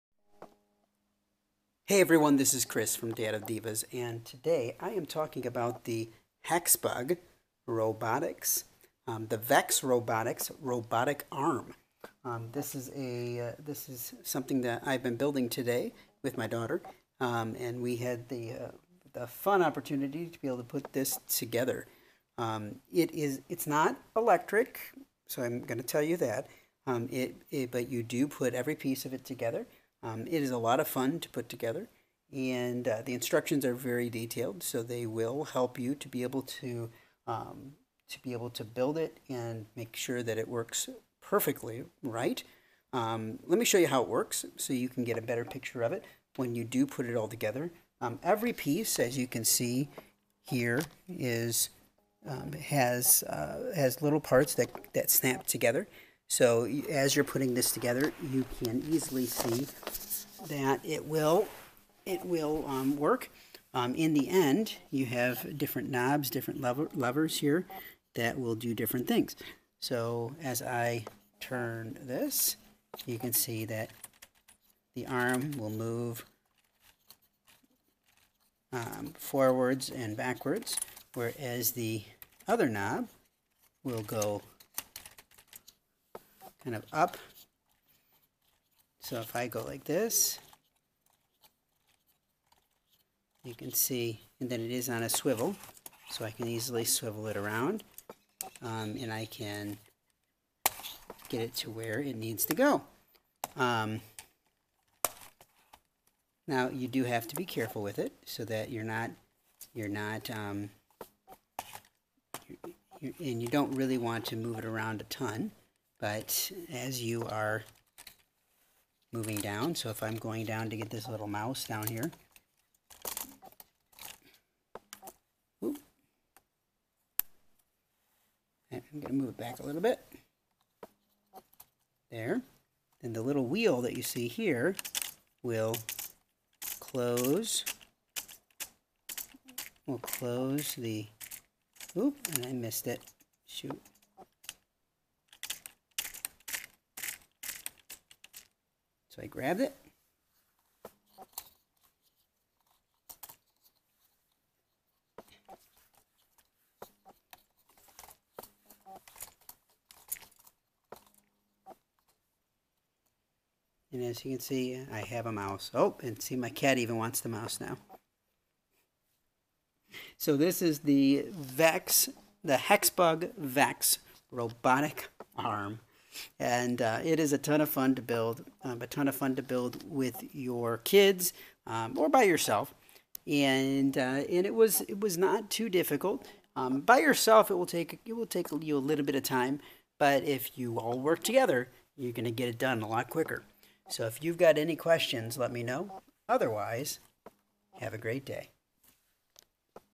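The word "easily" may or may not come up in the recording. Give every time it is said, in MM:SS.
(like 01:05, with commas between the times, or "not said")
00:58, 01:36.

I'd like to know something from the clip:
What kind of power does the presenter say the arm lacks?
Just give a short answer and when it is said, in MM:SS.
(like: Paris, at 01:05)
Electric, at 00:24.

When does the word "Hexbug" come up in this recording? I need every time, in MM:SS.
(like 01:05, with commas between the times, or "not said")
00:06, 02:52.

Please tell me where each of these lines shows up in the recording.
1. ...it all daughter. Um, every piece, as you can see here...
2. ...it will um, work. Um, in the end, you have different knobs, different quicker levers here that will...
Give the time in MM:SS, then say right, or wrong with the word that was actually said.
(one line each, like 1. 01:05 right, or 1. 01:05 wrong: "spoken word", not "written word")
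1. 00:47 wrong: "together", not "daughter"
2. 01:02 wrong: "lever", not "quicker".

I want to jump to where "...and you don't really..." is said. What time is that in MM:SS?
01:53.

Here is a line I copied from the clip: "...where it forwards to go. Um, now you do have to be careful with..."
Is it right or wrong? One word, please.
wrong.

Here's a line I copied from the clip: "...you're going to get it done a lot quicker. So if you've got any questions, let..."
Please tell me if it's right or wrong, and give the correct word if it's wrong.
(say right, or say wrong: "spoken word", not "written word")
right.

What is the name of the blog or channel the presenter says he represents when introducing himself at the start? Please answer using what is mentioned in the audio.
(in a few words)
Dad of Divas.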